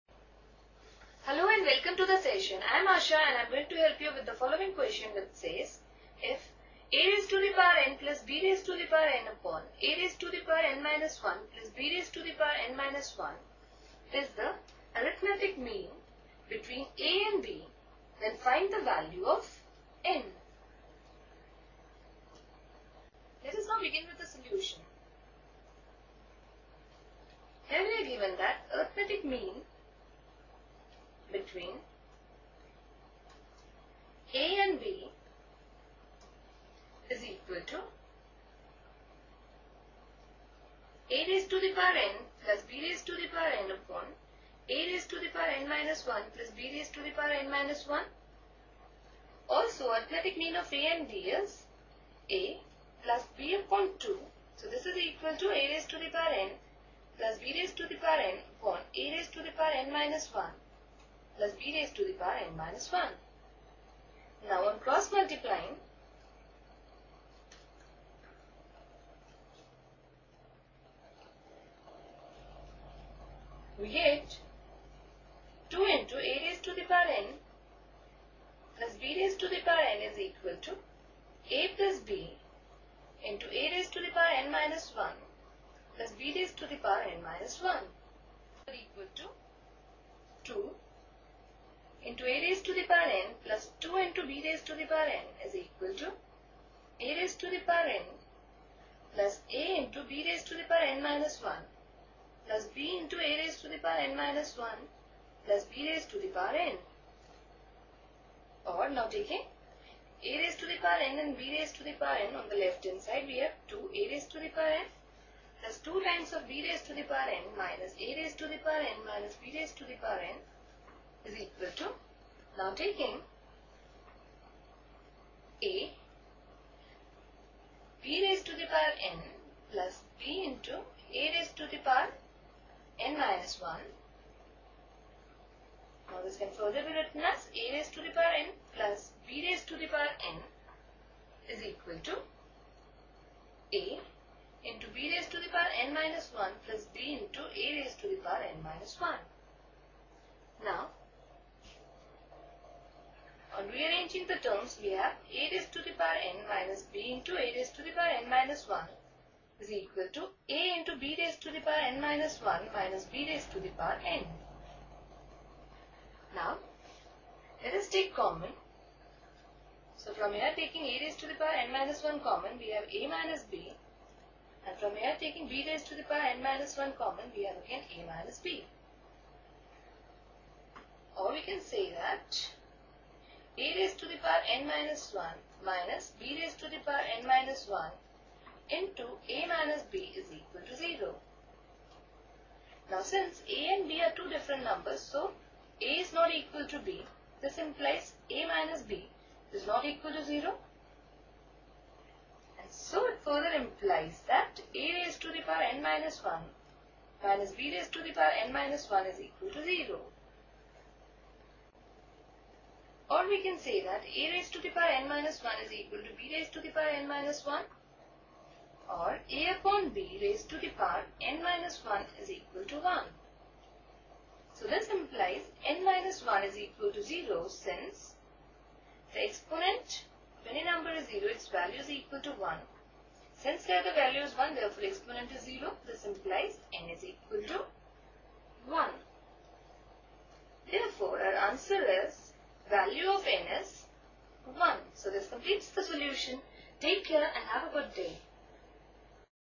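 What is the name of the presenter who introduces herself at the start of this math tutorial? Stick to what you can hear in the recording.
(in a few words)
Asha.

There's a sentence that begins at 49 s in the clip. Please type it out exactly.
Also, arithmetic mean of a and b is a plus b upon 2.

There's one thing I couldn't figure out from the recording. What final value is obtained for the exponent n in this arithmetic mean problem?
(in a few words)
1.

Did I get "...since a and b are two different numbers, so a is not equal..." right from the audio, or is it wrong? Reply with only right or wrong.
right.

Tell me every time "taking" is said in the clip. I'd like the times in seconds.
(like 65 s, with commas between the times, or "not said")
109 s, 122 s, 170 s, 175 s.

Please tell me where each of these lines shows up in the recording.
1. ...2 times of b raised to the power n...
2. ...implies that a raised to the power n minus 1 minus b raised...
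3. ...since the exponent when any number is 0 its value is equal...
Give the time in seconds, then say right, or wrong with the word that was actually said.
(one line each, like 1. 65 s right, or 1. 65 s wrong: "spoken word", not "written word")
1. 115 s right
2. 203 s right
3. 227 s right.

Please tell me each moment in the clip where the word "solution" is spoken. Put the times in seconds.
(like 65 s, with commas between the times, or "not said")
24 s, 245 s.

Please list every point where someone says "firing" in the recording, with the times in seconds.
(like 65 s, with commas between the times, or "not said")
not said.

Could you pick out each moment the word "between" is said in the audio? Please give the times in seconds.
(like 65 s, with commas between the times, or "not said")
16 s, 31 s.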